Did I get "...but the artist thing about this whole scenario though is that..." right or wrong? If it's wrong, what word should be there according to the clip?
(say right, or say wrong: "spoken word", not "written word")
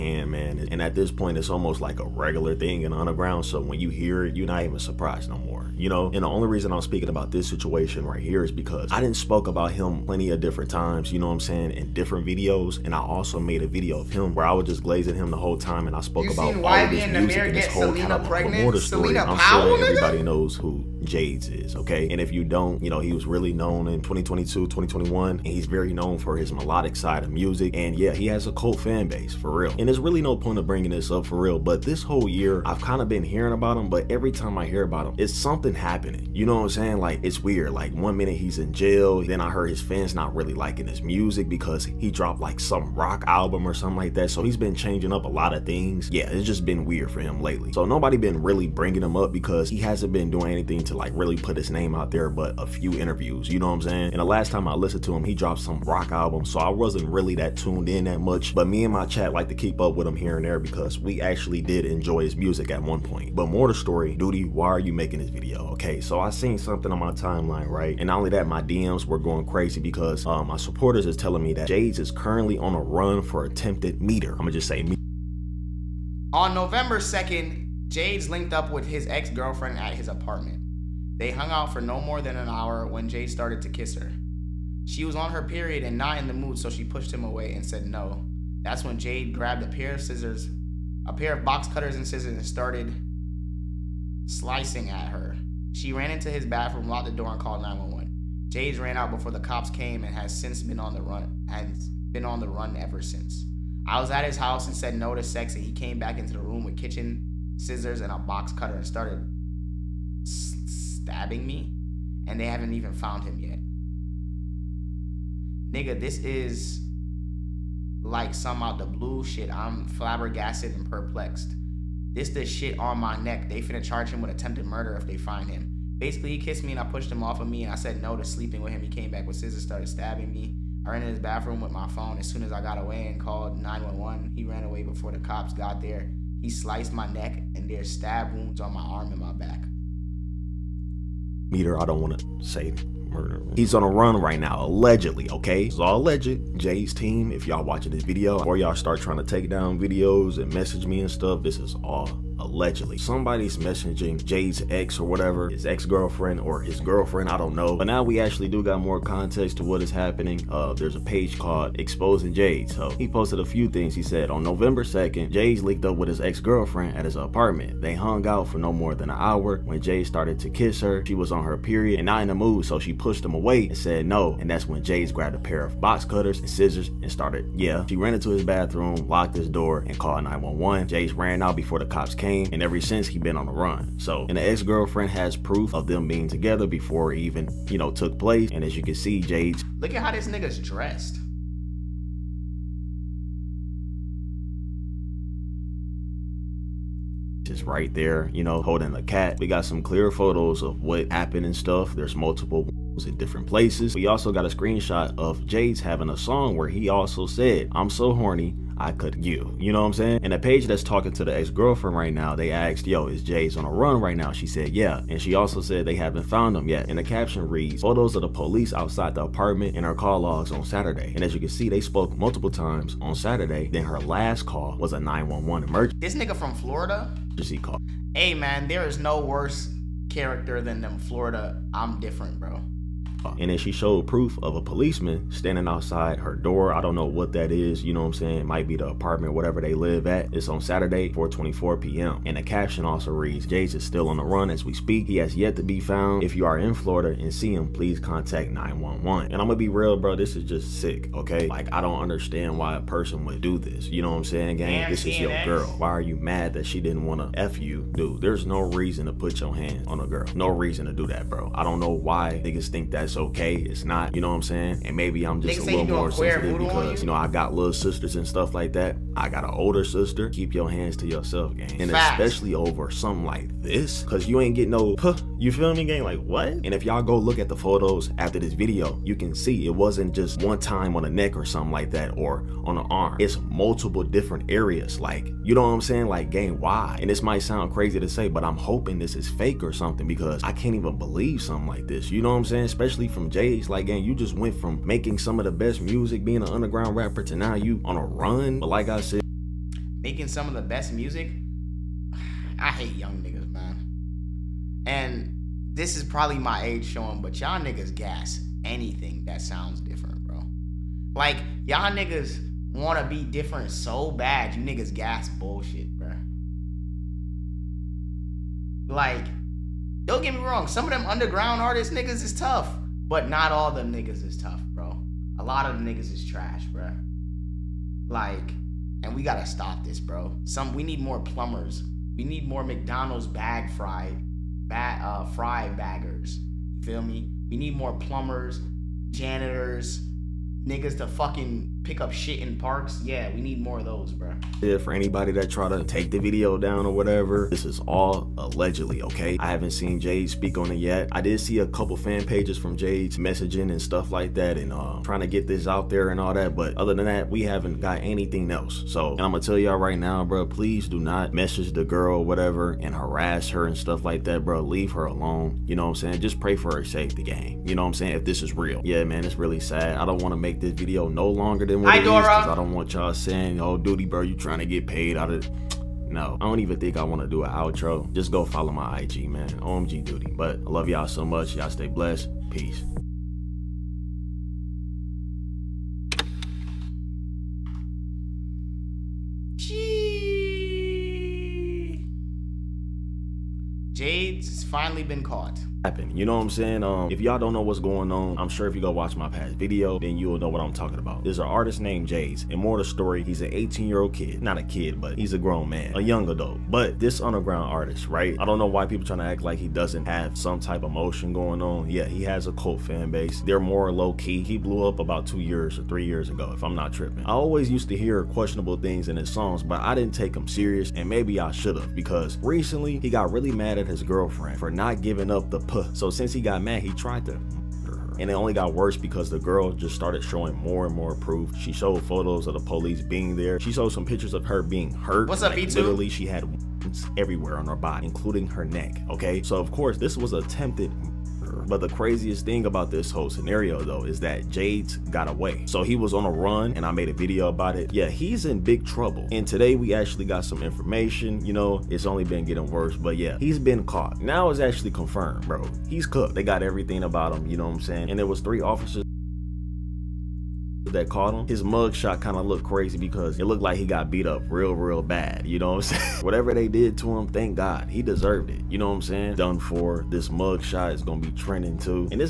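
wrong: "craziest", not "artist".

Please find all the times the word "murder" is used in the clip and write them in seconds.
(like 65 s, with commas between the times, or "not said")
124 s, 143 s, 427 s.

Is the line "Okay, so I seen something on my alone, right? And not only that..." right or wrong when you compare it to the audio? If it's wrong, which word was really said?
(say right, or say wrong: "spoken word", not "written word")
wrong: "timeline", not "alone".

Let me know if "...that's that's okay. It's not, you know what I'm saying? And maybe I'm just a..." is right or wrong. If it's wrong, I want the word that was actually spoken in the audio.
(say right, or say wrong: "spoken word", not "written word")
right.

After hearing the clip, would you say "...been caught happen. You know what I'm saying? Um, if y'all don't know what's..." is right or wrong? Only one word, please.
right.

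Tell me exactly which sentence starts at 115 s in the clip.
Nigga, this is like some out the blue shit.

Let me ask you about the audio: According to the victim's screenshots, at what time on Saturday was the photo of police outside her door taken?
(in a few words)
4:24 p.m.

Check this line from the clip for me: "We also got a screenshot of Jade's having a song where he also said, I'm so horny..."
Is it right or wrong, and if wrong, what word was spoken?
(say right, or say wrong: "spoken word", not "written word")
right.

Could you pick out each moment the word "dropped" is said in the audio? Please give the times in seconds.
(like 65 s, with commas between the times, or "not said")
42 s, 55 s.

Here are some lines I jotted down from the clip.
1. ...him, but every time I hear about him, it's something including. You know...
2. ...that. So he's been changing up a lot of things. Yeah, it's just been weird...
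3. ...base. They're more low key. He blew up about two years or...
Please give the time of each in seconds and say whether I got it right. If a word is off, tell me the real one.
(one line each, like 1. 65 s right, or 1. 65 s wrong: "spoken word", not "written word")
1. 33 s wrong: "happening", not "including"
2. 44 s right
3. 413 s right.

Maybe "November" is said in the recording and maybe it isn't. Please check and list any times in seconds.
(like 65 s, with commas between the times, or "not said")
76 s, 164 s.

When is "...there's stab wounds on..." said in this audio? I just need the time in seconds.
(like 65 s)
137 s.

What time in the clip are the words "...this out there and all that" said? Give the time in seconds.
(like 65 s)
355 s.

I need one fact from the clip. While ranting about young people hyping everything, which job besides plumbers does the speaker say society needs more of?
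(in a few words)
janitors.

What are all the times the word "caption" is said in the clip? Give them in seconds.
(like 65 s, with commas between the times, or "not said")
217 s, 242 s.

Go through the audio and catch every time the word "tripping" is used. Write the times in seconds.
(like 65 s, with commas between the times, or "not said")
416 s.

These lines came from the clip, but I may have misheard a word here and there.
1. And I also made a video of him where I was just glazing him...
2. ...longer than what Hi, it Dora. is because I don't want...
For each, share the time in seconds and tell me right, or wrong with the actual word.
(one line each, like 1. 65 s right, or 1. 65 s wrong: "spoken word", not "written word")
1. 12 s right
2. 371 s right.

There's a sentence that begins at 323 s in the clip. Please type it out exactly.
But not all them niggas is tough, bro.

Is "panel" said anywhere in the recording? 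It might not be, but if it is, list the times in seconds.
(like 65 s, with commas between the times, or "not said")
not said.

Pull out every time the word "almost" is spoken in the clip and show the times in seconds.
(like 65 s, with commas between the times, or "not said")
1 s.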